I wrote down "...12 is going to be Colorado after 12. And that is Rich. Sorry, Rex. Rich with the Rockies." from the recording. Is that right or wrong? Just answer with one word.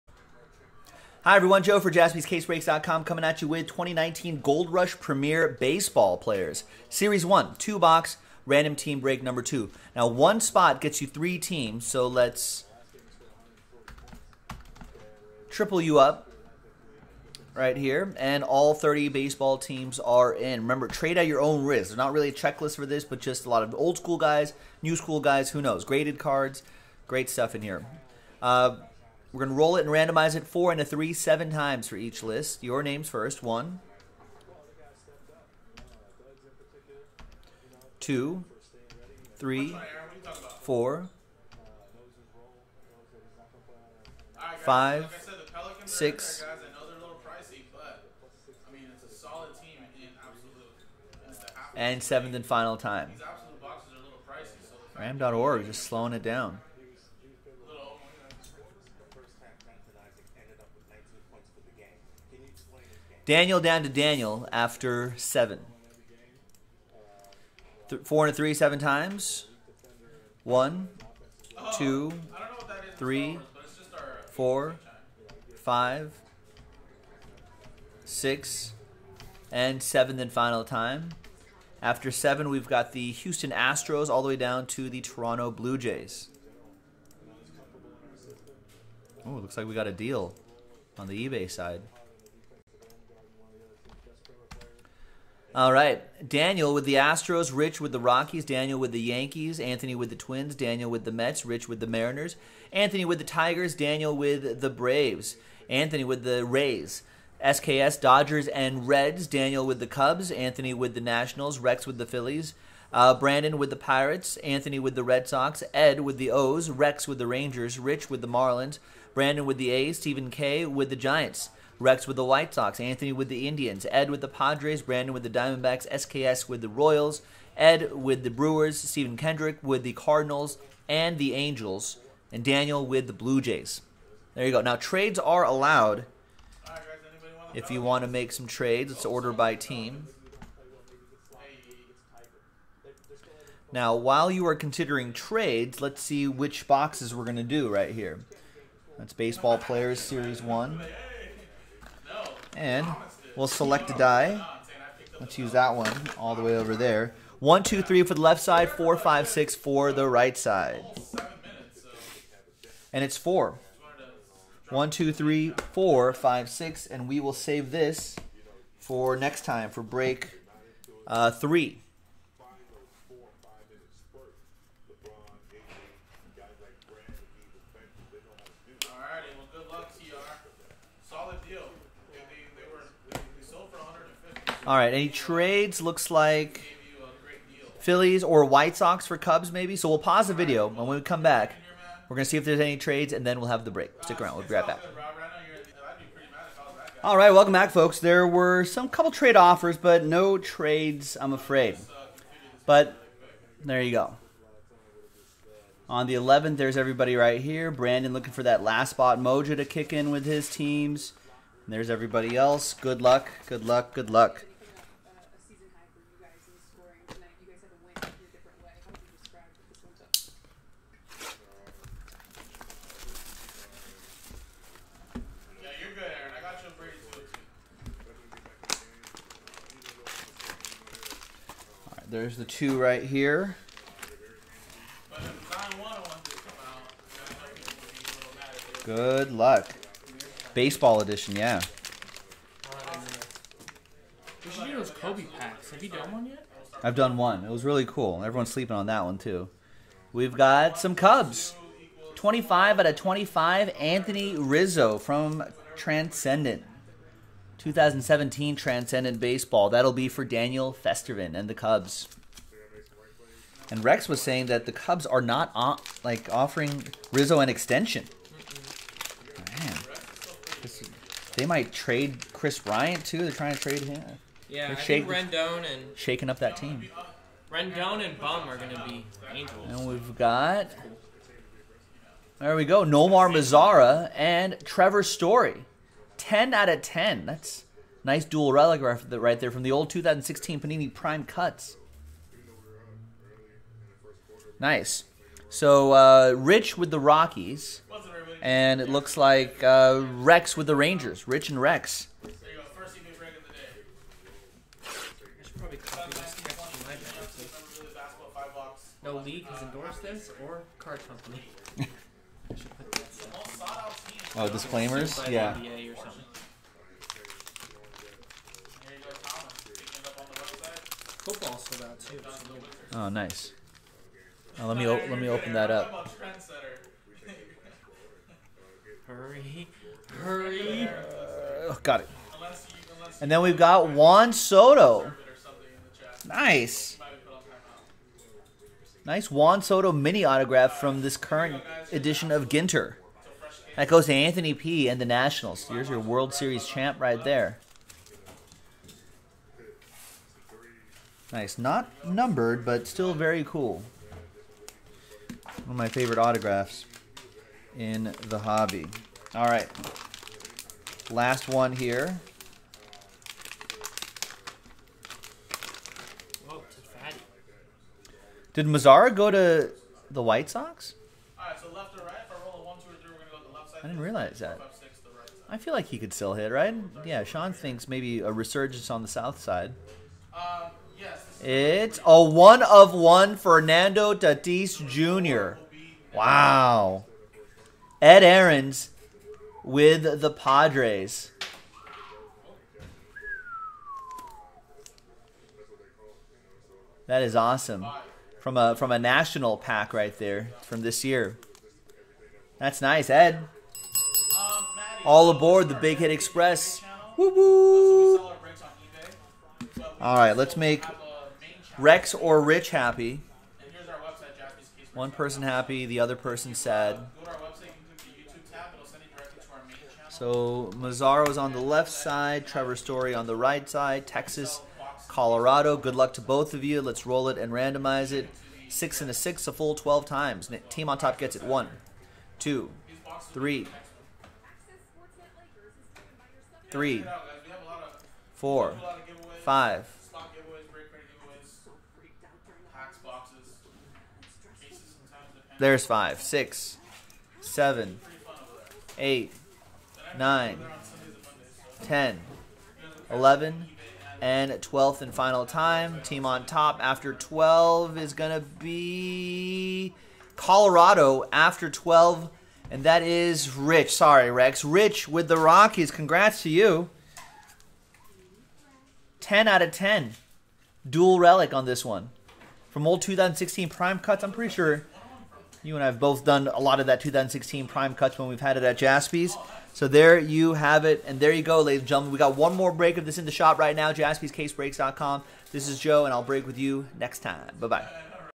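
right.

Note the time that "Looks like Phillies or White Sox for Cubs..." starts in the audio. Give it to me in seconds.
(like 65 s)
185 s.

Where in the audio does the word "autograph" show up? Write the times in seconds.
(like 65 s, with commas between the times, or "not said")
340 s, 356 s.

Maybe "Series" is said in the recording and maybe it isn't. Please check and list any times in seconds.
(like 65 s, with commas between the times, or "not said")
6 s, 150 s, 346 s.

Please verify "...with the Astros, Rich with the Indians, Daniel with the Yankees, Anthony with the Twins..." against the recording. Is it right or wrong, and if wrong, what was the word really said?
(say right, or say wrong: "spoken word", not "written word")
wrong: "Rockies", not "Indians".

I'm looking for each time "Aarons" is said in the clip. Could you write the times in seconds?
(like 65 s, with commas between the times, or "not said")
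388 s.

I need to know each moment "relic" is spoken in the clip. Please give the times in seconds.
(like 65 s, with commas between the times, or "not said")
288 s, 471 s.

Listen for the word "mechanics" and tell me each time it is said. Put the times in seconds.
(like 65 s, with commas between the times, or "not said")
not said.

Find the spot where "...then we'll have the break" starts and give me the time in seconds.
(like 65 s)
193 s.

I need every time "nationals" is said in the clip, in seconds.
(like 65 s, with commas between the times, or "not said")
111 s, 345 s, 398 s.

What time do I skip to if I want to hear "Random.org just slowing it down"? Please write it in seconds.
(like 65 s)
54 s.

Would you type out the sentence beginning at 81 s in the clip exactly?
After seven, we've got the Houston Astros all the way down to the Toronto Blue Jays.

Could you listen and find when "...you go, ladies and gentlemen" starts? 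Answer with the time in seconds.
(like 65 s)
481 s.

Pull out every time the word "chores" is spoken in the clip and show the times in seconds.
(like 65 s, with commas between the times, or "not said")
not said.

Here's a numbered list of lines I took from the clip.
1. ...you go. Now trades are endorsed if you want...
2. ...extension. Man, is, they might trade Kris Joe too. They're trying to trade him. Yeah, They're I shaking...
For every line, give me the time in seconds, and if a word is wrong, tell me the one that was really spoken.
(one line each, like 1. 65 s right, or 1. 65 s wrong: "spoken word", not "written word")
1. 134 s wrong: "allowed", not "endorsed"
2. 267 s wrong: "Bryant", not "Joe".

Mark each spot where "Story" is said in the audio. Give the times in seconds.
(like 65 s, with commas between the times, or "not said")
285 s, 422 s.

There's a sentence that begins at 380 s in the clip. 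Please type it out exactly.
Um, yes, it's a one of one Fernando Tatis Jr.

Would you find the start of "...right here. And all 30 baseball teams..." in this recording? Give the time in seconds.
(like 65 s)
17 s.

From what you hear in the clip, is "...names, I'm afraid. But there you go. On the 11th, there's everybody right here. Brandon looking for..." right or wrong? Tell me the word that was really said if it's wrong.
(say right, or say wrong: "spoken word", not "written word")
wrong: "trades", not "names".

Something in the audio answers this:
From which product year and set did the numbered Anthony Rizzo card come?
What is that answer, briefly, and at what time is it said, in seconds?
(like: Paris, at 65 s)
2017 Transcendent, at 257 s.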